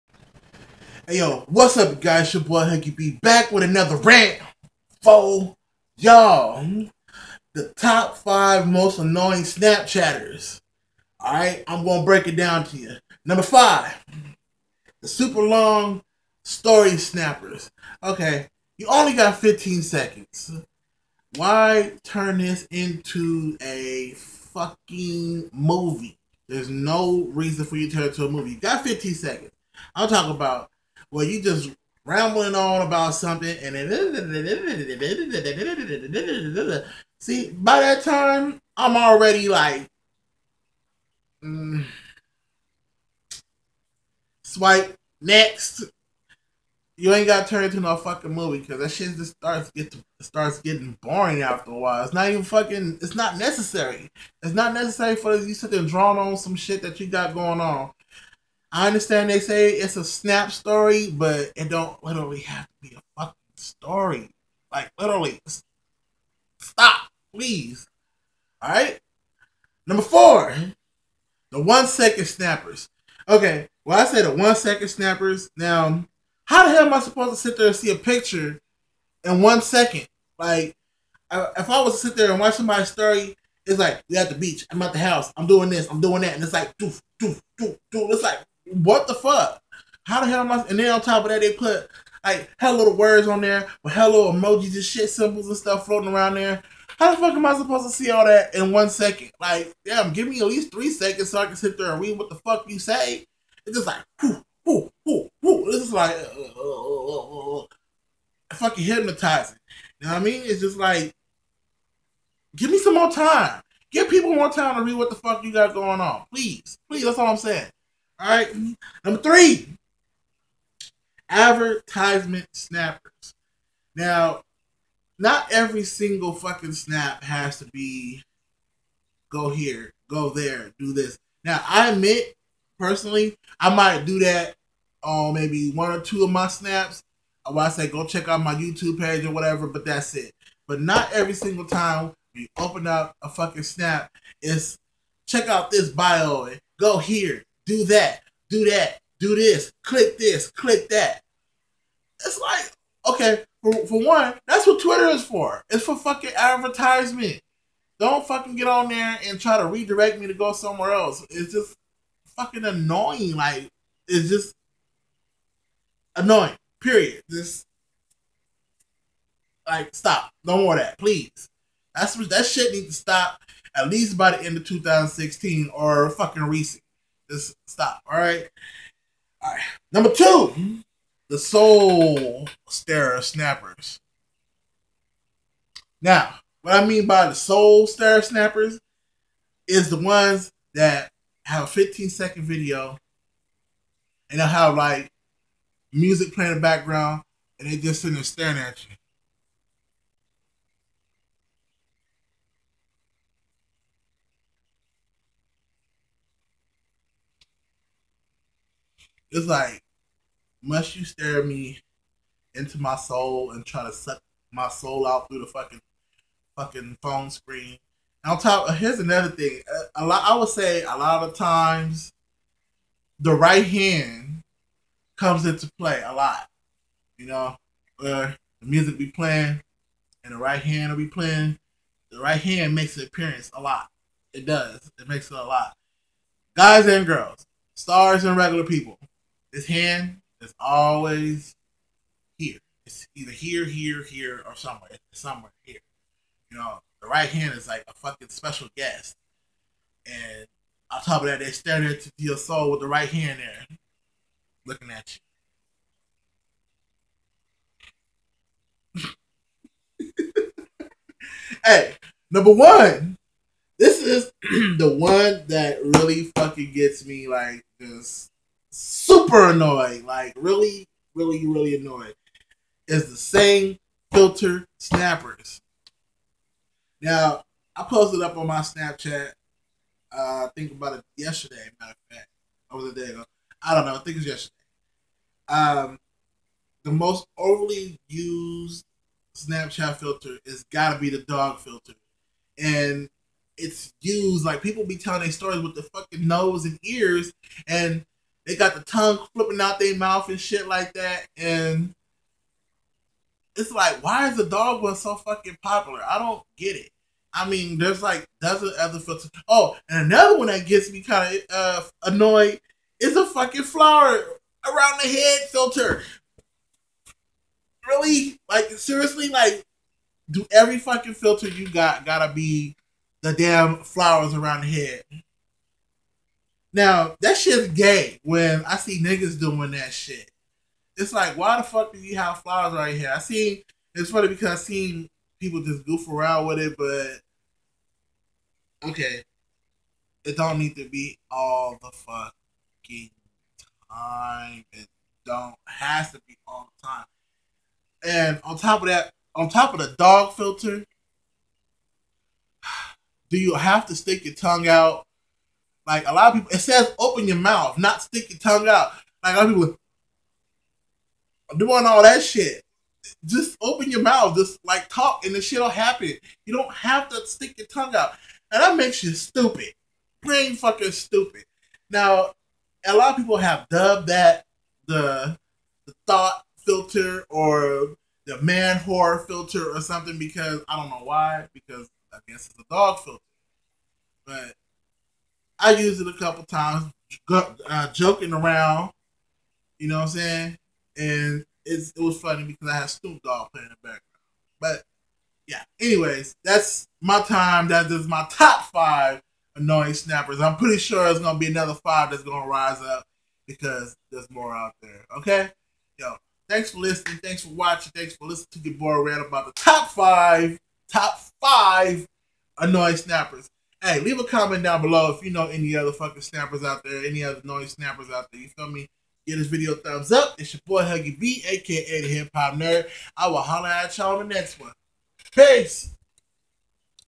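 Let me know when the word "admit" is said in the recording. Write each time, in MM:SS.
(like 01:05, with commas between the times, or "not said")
02:11.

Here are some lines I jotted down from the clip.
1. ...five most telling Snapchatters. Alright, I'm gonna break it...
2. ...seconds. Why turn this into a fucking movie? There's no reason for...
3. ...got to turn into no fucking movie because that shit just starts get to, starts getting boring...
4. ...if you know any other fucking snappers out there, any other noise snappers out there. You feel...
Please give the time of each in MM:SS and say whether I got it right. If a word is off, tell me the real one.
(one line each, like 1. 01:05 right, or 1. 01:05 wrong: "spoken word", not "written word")
1. 00:08 wrong: "annoying", not "telling"
2. 00:19 right
3. 00:47 right
4. 06:55 right.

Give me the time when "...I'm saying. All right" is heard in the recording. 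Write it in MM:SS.
01:57.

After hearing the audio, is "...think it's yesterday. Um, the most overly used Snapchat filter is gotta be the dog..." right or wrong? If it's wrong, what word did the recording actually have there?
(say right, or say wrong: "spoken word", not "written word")
right.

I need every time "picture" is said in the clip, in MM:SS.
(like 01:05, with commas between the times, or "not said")
01:17.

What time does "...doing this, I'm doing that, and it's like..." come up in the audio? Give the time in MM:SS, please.
01:25.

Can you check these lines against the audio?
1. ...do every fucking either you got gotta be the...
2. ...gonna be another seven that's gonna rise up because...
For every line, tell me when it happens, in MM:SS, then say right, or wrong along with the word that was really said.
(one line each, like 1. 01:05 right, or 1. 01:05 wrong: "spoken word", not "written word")
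1. 05:20 wrong: "filter", not "either"
2. 06:41 wrong: "five", not "seven".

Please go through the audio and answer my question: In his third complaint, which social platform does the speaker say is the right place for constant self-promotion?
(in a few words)
Twitter.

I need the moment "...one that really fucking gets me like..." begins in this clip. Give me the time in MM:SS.
04:24.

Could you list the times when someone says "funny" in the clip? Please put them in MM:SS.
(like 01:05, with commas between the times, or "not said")
05:34, 06:32.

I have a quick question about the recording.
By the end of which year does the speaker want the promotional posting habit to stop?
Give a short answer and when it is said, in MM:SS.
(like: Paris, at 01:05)
2016, at 02:54.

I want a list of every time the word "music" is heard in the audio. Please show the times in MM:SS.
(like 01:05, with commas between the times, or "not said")
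03:15, 03:48.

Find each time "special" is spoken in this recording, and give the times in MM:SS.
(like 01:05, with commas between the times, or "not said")
04:08.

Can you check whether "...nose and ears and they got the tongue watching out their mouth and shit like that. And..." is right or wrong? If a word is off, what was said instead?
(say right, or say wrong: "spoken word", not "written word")
wrong: "flipping", not "watching".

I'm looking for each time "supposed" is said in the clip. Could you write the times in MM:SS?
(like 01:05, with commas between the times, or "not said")
01:16, 01:37.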